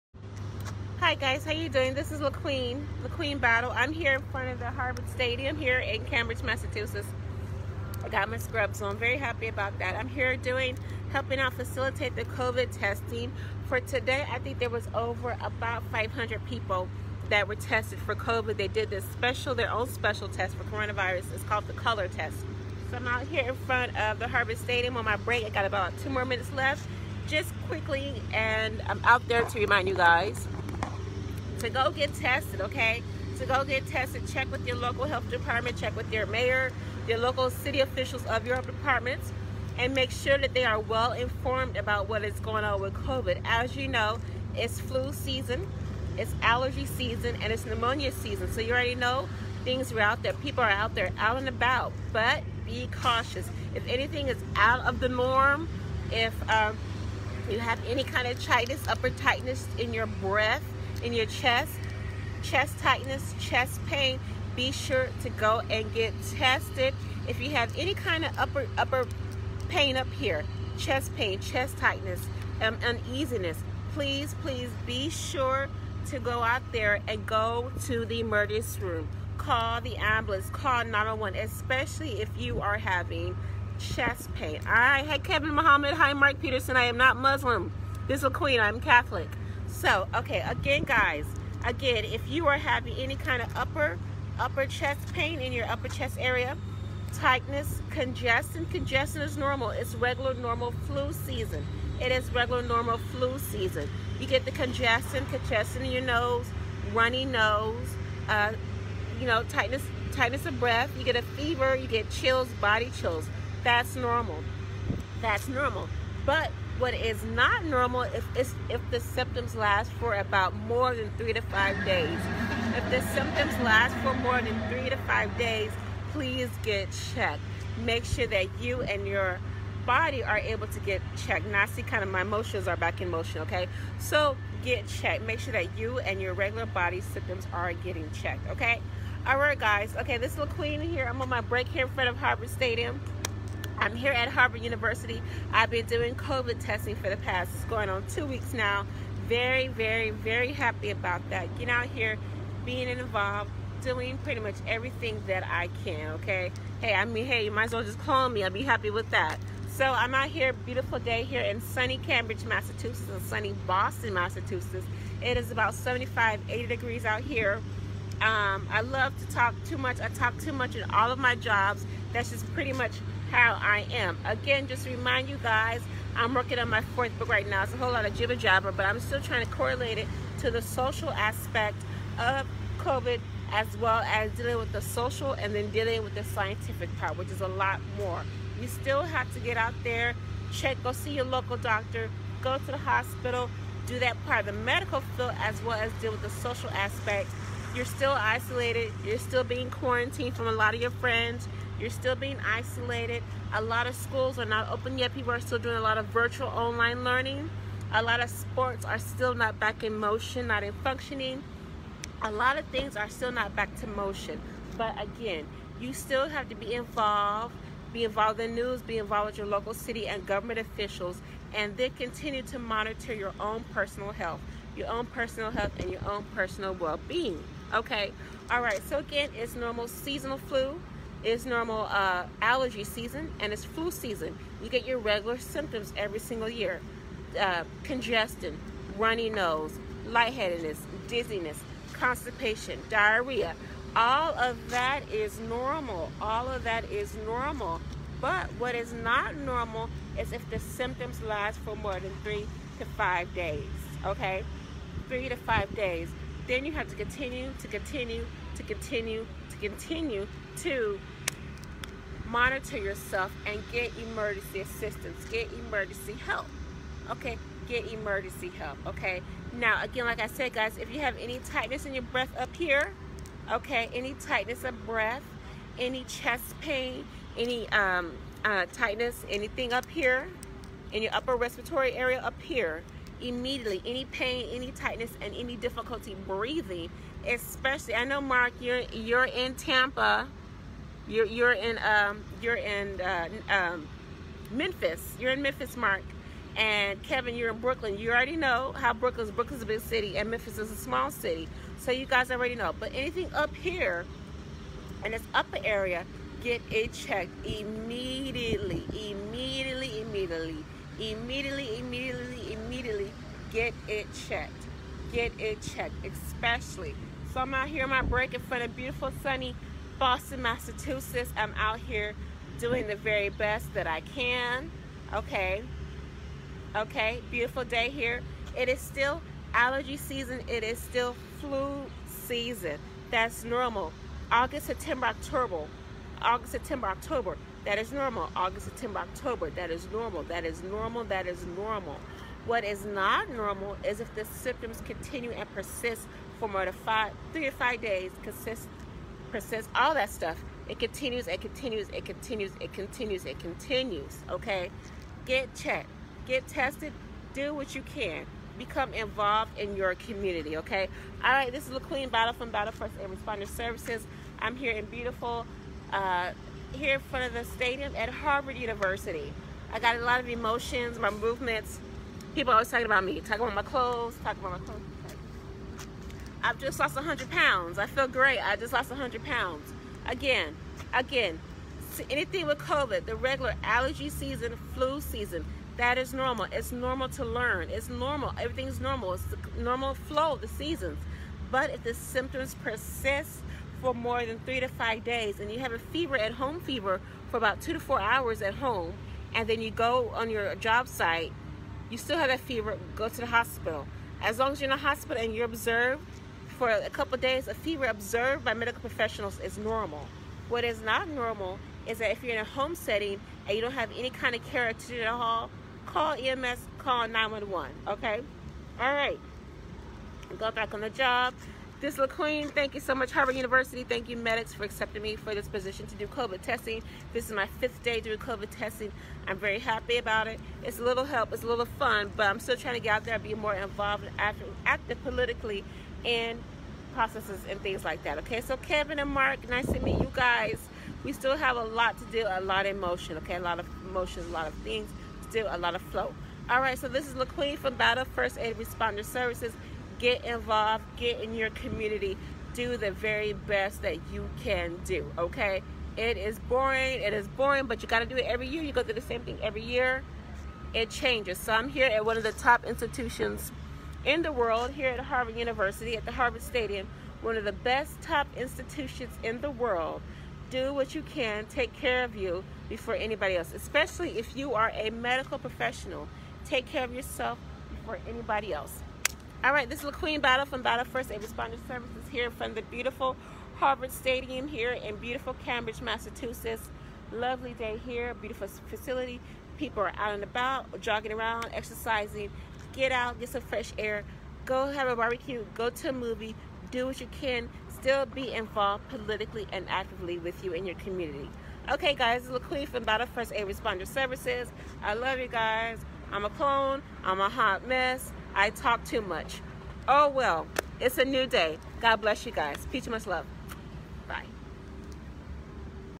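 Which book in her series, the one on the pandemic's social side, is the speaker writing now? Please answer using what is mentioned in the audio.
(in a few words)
fourth.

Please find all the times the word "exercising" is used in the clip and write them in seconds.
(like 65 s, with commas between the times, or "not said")
491 s.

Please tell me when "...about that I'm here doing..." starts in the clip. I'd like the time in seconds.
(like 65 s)
9 s.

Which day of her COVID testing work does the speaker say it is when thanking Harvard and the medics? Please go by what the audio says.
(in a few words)
fifth day.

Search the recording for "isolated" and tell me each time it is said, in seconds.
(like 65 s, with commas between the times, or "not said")
198 s, 202 s.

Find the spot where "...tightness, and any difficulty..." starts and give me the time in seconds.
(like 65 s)
284 s.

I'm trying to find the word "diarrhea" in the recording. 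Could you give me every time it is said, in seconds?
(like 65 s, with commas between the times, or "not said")
242 s.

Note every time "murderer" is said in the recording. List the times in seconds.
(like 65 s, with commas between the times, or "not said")
not said.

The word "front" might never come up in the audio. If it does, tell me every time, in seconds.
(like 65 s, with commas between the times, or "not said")
4 s, 23 s, 141 s, 318 s, 367 s.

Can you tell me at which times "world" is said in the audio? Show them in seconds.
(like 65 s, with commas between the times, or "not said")
464 s, 469 s.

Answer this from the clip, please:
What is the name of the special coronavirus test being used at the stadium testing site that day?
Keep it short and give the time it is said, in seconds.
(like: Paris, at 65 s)
color test, at 21 s.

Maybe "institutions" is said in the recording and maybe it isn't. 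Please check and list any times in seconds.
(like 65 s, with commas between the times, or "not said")
462 s, 468 s.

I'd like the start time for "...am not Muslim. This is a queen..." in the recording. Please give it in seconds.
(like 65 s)
86 s.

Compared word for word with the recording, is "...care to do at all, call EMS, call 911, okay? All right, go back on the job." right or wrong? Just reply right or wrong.
right.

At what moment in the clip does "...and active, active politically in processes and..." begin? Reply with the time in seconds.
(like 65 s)
434 s.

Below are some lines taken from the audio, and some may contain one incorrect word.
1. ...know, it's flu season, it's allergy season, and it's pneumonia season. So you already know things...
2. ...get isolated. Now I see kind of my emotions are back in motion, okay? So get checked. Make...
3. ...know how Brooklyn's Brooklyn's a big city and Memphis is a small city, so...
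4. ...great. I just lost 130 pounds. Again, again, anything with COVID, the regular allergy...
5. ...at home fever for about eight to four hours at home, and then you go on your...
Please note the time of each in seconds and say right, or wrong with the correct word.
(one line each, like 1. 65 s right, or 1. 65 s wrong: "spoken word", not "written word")
1. 43 s right
2. 130 s wrong: "checked", not "isolated"
3. 298 s right
4. 378 s wrong: "100", not "130"
5. 396 s wrong: "two", not "eight".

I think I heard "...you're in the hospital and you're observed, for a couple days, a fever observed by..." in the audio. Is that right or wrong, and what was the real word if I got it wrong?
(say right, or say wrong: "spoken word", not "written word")
right.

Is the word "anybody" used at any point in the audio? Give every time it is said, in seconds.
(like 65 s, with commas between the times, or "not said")
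472 s, 478 s.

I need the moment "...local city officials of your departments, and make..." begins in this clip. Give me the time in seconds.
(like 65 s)
37 s.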